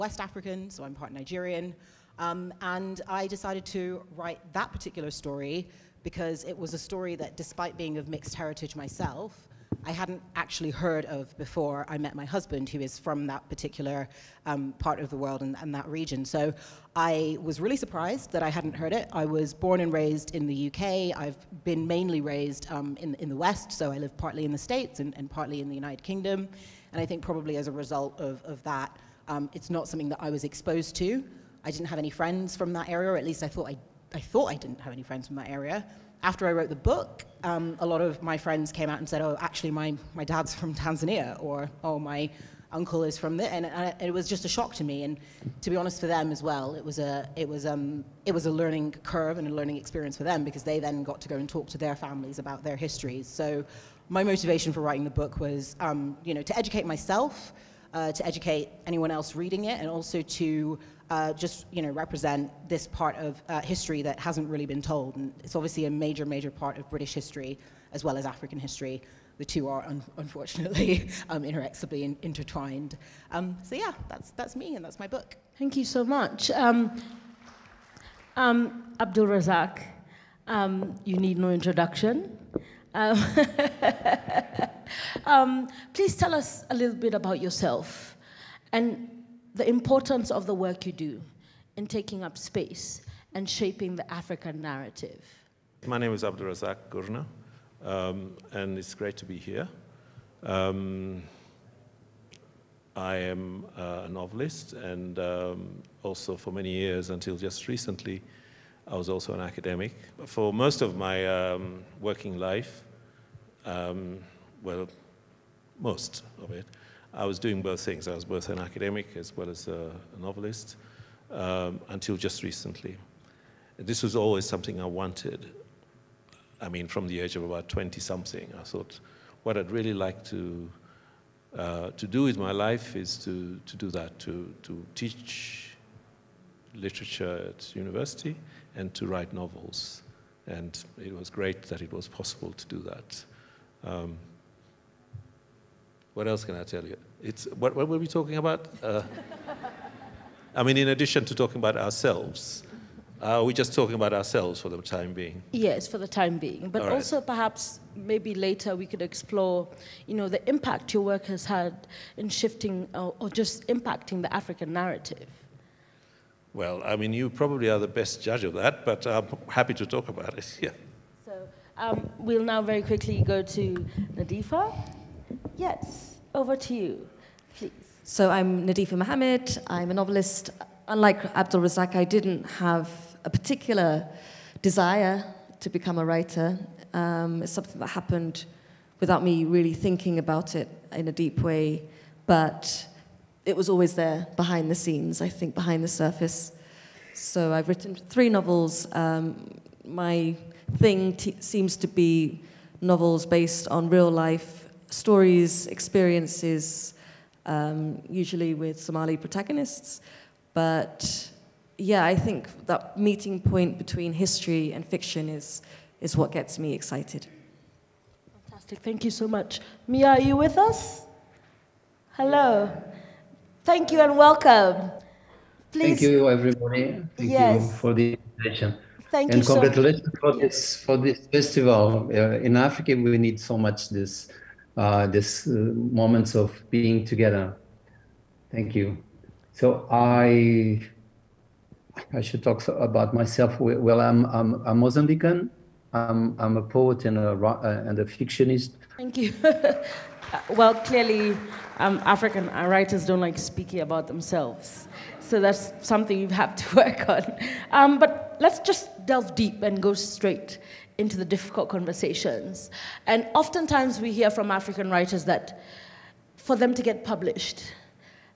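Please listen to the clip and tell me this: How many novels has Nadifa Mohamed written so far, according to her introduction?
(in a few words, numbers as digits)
3.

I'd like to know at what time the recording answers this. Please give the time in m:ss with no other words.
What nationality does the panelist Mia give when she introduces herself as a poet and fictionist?
4:04.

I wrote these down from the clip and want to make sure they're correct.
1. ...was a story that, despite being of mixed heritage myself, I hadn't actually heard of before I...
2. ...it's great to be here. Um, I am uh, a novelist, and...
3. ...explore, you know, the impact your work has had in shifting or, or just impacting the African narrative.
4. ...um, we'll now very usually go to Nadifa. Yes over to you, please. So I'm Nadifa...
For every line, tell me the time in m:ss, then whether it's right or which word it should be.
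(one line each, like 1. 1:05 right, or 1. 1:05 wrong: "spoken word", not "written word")
1. 0:06 right
2. 1:38 right
3. 2:39 right
4. 2:51 wrong: "quickly", not "usually".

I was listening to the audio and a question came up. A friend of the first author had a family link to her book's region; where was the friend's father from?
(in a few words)
Tanzania.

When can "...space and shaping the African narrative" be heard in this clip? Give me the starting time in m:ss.
1:32.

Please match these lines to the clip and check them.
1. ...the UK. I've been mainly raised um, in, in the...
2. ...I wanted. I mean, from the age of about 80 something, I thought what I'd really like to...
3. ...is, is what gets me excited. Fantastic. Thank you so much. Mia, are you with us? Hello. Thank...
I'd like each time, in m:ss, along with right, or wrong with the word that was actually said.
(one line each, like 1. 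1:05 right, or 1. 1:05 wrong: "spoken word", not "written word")
1. 0:20 right
2. 2:04 wrong: "20", not "80"
3. 3:35 right.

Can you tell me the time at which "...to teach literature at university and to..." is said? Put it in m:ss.
2:14.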